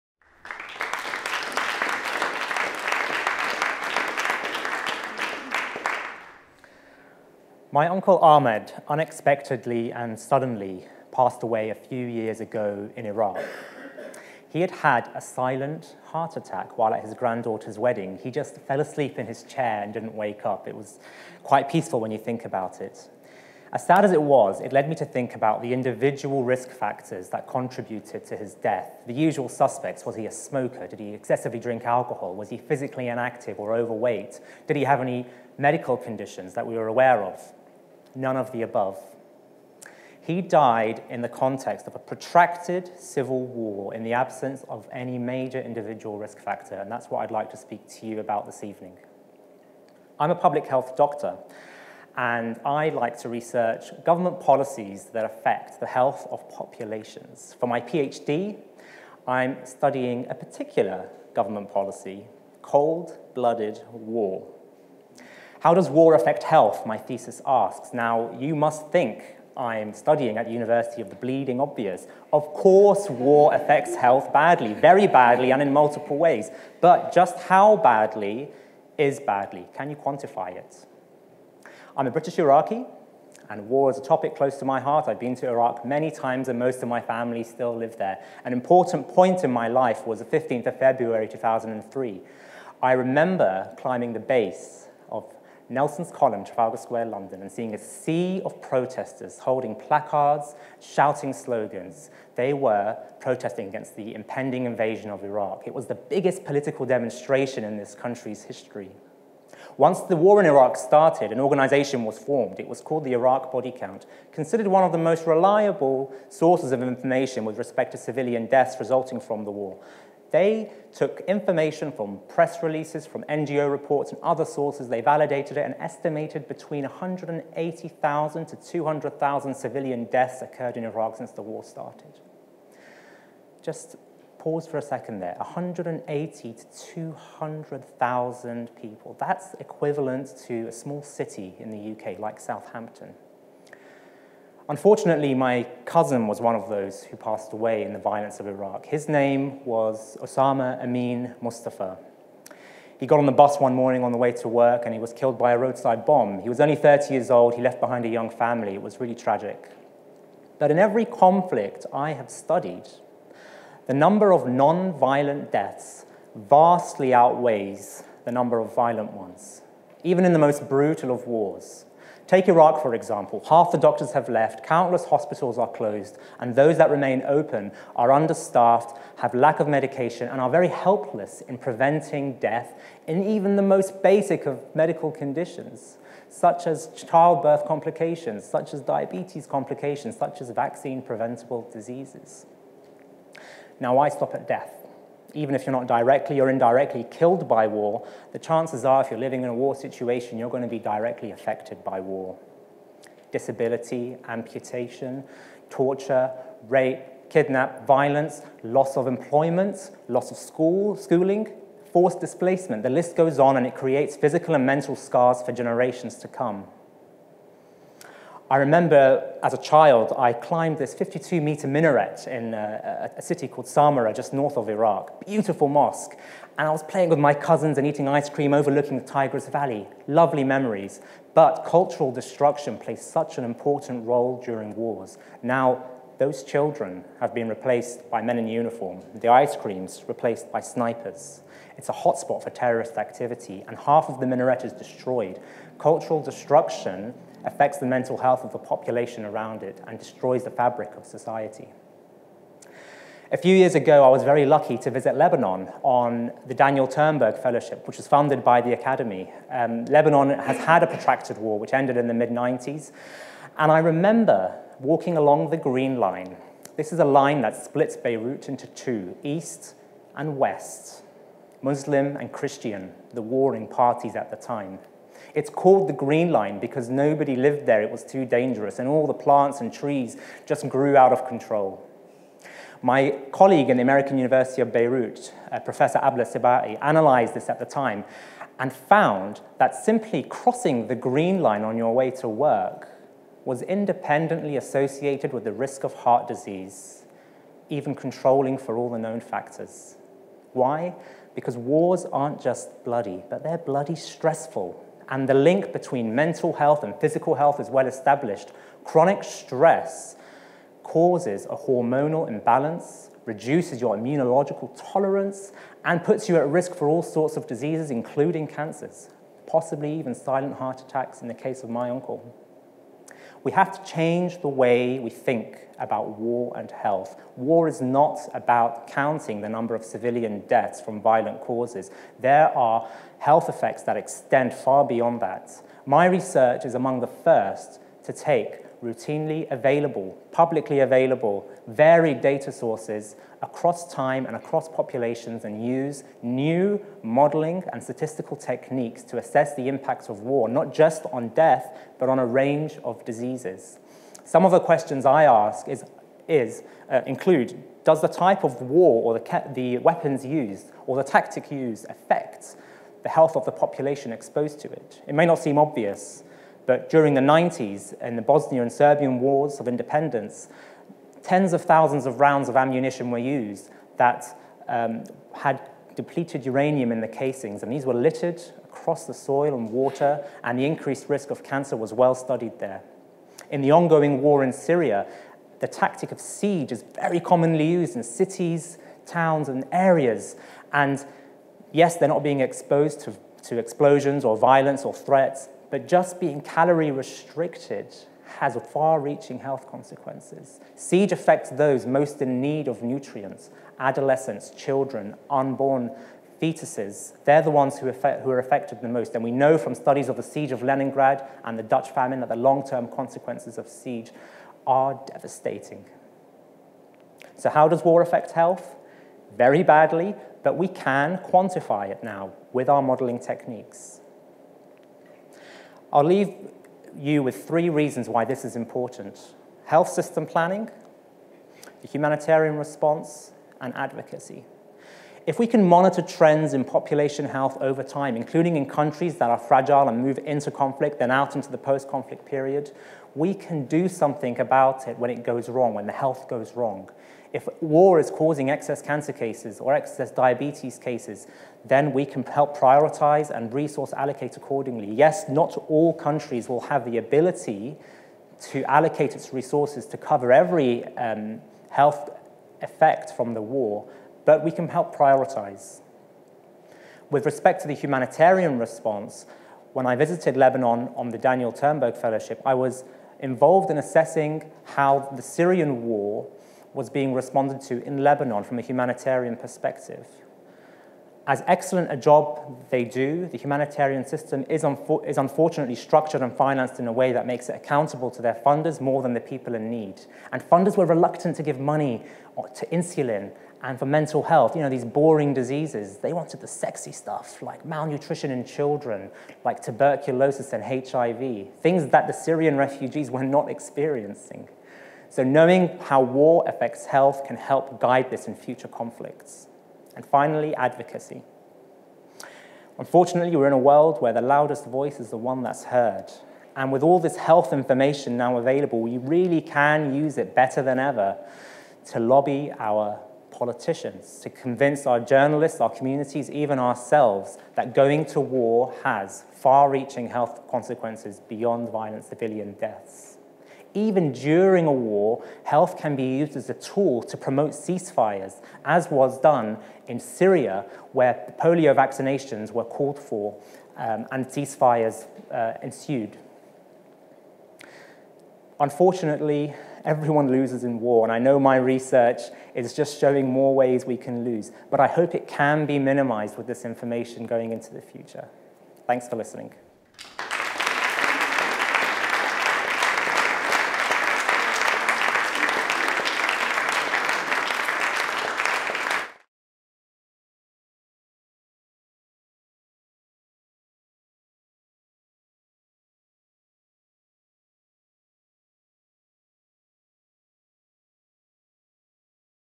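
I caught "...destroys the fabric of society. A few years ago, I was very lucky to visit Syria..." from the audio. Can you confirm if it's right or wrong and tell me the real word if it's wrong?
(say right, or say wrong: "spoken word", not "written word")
wrong: "Lebanon", not "Syria".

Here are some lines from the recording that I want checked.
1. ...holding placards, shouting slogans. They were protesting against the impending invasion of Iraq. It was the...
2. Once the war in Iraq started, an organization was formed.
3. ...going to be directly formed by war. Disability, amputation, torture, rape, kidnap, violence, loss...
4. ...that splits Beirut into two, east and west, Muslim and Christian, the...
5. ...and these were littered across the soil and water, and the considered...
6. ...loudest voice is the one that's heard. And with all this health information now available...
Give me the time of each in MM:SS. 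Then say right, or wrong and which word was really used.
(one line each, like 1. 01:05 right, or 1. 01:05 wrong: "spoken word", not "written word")
1. 01:39 right
2. 01:49 right
3. 03:20 wrong: "affected", not "formed"
4. 04:27 right
5. 06:17 wrong: "increased", not "considered"
6. 08:34 right.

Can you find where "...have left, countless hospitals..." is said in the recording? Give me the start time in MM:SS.
02:54.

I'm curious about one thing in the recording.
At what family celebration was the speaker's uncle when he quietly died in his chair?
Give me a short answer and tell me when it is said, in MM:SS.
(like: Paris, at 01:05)
His granddaughter's wedding, at 00:17.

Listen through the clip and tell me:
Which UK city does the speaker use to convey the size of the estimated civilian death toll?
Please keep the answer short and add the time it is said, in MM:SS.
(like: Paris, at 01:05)
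Southampton, at 02:22.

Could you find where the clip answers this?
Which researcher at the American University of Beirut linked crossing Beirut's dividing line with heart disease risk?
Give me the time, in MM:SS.
04:45.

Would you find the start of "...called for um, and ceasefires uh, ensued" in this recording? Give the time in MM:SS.
09:02.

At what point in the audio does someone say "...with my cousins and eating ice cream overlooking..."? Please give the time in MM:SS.
03:47.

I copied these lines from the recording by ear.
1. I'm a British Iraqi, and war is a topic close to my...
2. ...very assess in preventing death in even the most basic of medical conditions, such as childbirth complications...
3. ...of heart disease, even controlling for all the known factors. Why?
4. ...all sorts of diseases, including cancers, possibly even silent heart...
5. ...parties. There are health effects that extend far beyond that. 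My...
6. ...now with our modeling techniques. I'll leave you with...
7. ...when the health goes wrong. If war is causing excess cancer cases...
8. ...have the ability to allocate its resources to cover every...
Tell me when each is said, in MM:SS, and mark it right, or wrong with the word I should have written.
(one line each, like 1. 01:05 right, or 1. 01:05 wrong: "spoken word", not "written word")
1. 01:21 right
2. 03:00 wrong: "helpless", not "assess"
3. 04:55 right
4. 05:16 right
5. 05:31 wrong: "causes", not "parties"
6. 07:02 right
7. 07:25 right
8. 07:36 right.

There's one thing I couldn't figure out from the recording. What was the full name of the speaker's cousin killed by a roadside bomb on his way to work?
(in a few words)
Osama Amin Mustafa.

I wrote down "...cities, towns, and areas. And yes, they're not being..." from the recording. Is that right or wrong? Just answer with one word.
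right.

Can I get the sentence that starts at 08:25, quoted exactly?
So knowing how war affects health can help guide this in future conflicts.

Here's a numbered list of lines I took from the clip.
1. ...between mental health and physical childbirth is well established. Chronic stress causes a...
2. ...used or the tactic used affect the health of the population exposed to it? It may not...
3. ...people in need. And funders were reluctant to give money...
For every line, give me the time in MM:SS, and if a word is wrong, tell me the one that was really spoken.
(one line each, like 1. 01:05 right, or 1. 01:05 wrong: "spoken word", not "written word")
1. 05:05 wrong: "health", not "childbirth"
2. 06:00 right
3. 08:09 right.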